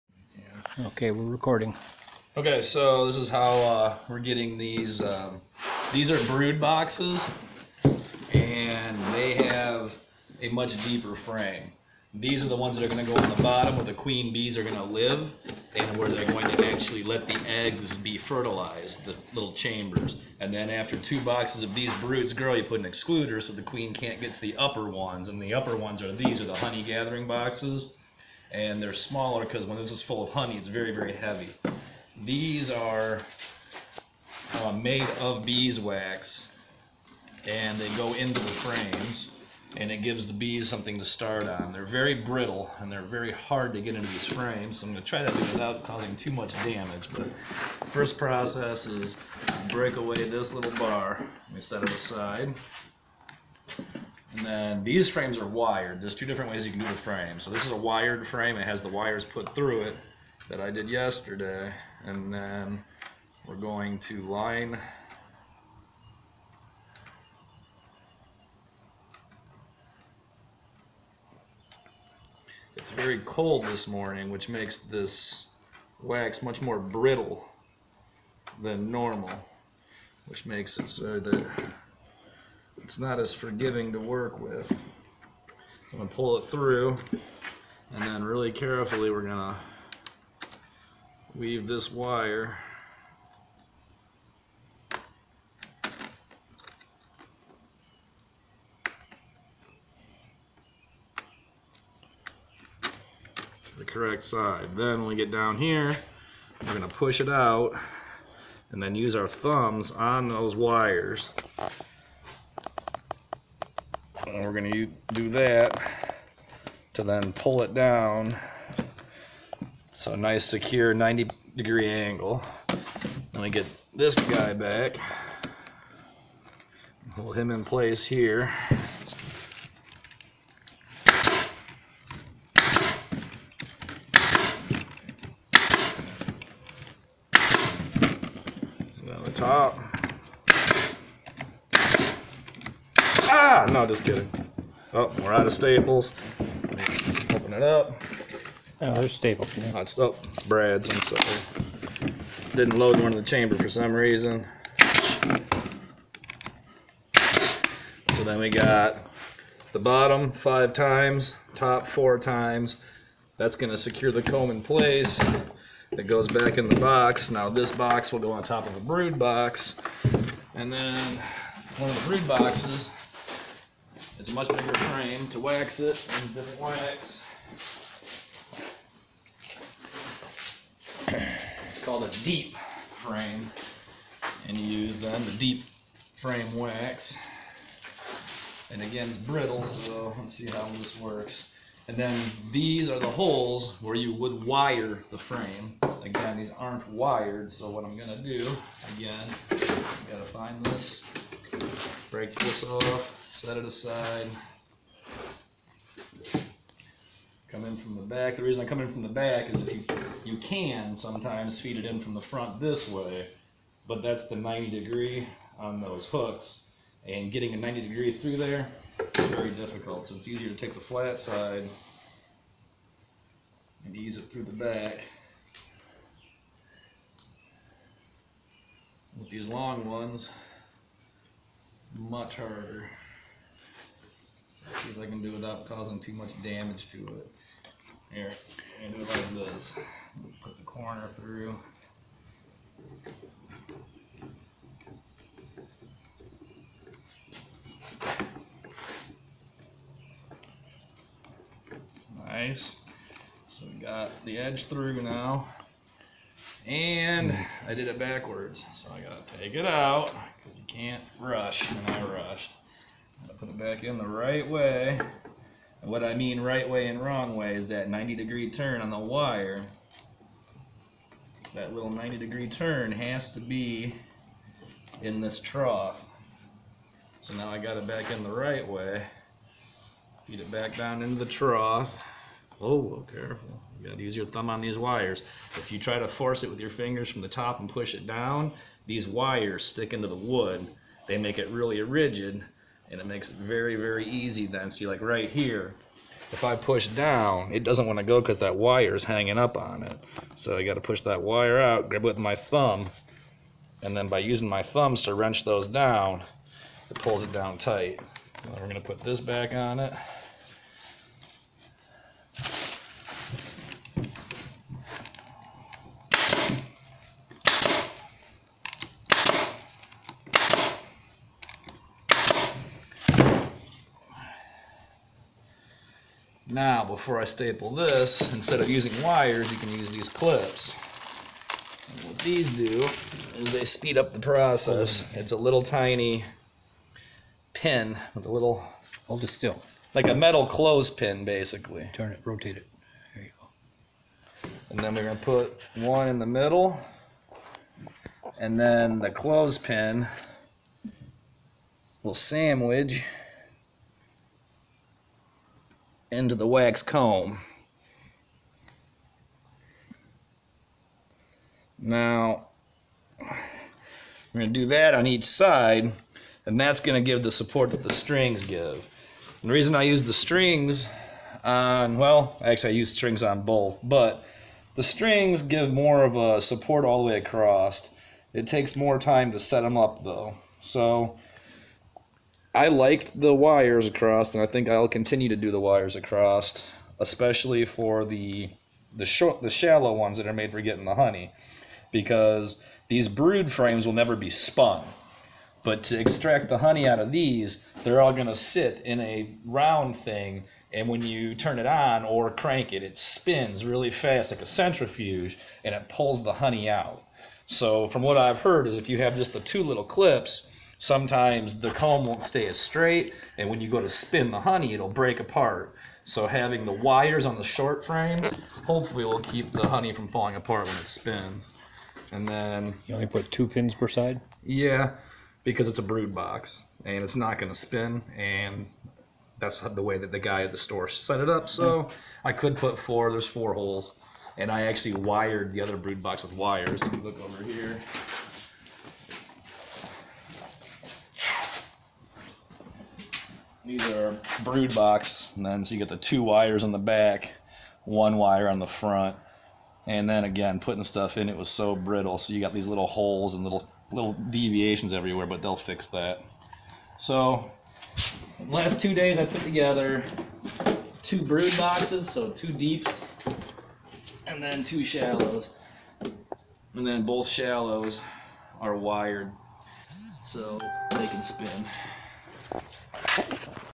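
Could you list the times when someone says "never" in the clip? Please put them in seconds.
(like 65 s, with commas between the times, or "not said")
393 s.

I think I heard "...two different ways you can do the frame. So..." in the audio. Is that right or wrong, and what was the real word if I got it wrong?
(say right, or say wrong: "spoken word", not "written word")
right.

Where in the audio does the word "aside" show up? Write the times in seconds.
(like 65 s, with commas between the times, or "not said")
51 s, 203 s.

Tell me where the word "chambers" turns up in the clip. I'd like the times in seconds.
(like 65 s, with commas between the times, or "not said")
19 s, 153 s.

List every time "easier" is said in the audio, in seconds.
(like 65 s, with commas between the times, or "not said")
220 s.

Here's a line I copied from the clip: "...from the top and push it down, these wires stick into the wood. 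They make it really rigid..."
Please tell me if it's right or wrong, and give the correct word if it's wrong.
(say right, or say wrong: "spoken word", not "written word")
right.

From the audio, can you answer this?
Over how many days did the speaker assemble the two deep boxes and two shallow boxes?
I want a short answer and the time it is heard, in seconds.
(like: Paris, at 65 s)
2, at 458 s.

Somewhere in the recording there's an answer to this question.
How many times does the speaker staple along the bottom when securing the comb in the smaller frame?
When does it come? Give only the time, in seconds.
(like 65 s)
160 s.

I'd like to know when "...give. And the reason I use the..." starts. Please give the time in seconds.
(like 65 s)
368 s.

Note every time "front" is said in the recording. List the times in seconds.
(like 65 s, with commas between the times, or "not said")
212 s, 448 s.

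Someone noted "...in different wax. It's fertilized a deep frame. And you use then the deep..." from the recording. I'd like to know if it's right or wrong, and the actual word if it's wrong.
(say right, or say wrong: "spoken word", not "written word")
wrong: "called", not "fertilized".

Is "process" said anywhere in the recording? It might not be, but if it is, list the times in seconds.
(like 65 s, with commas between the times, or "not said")
48 s, 334 s.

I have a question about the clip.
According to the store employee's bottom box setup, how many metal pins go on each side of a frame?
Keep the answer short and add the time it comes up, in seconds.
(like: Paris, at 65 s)
2, at 423 s.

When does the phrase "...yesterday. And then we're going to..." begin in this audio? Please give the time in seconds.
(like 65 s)
60 s.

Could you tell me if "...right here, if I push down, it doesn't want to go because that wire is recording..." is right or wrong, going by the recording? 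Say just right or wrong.
wrong.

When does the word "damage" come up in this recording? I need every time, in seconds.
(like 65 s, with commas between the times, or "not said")
46 s, 236 s.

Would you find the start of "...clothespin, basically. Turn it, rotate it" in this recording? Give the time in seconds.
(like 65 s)
340 s.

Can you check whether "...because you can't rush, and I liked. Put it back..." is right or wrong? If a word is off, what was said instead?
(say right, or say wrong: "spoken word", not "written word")
wrong: "rushed", not "liked".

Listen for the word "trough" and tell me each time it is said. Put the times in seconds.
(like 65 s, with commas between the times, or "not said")
275 s, 281 s.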